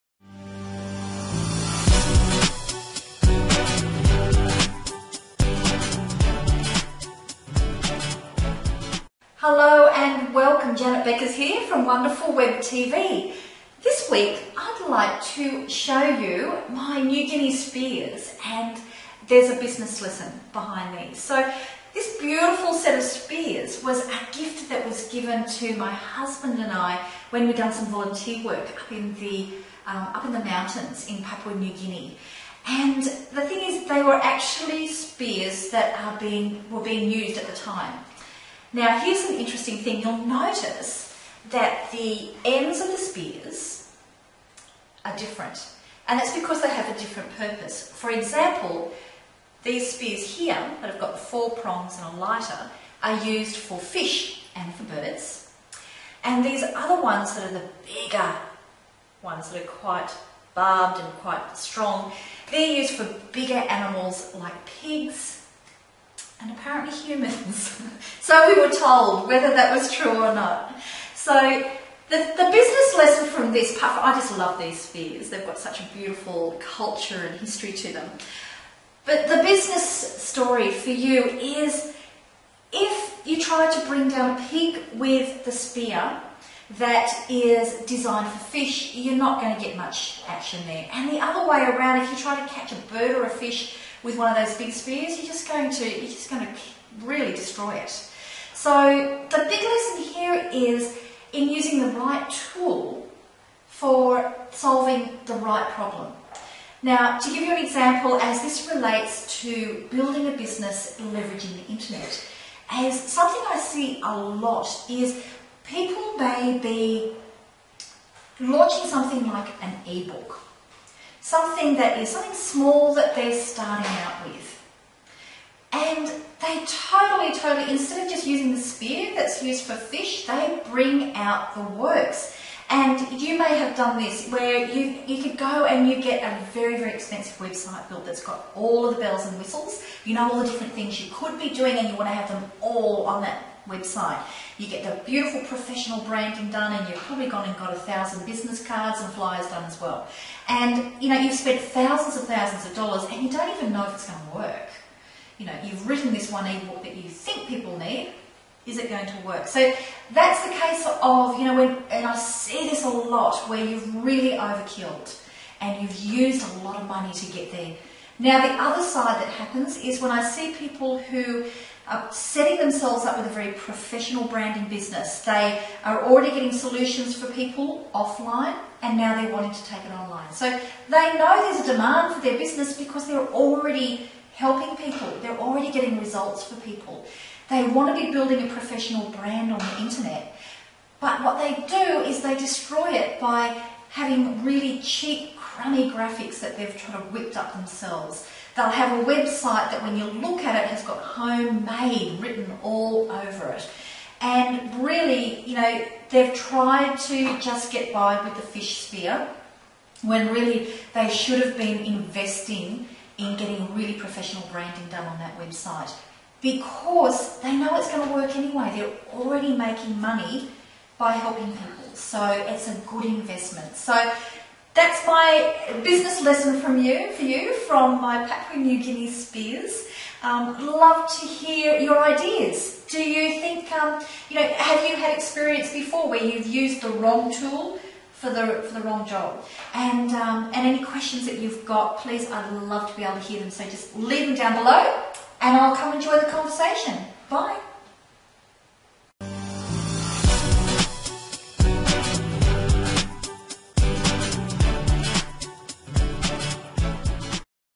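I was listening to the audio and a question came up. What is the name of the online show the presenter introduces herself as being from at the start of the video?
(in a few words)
Wonderful Web TV.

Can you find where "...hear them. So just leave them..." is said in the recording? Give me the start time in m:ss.
4:03.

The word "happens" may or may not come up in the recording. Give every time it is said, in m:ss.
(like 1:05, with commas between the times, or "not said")
2:49.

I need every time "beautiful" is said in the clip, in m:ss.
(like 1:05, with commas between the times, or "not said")
0:22, 1:15, 2:25.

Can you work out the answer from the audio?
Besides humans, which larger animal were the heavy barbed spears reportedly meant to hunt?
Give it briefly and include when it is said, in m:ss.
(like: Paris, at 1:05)
pigs, at 1:04.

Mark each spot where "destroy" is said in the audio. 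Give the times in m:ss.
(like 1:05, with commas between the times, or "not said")
1:37, 3:12.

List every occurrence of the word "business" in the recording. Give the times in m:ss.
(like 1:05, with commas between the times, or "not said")
0:19, 1:12, 1:19, 1:50, 2:28, 2:54, 3:02, 3:45.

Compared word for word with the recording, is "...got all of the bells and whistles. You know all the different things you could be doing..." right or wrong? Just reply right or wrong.
right.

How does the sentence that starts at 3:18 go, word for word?
They'll have a website that when you look at it has got homemade written all over it.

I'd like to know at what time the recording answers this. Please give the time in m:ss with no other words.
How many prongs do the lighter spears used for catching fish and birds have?
0:51.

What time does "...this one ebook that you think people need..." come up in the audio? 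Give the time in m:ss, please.
2:36.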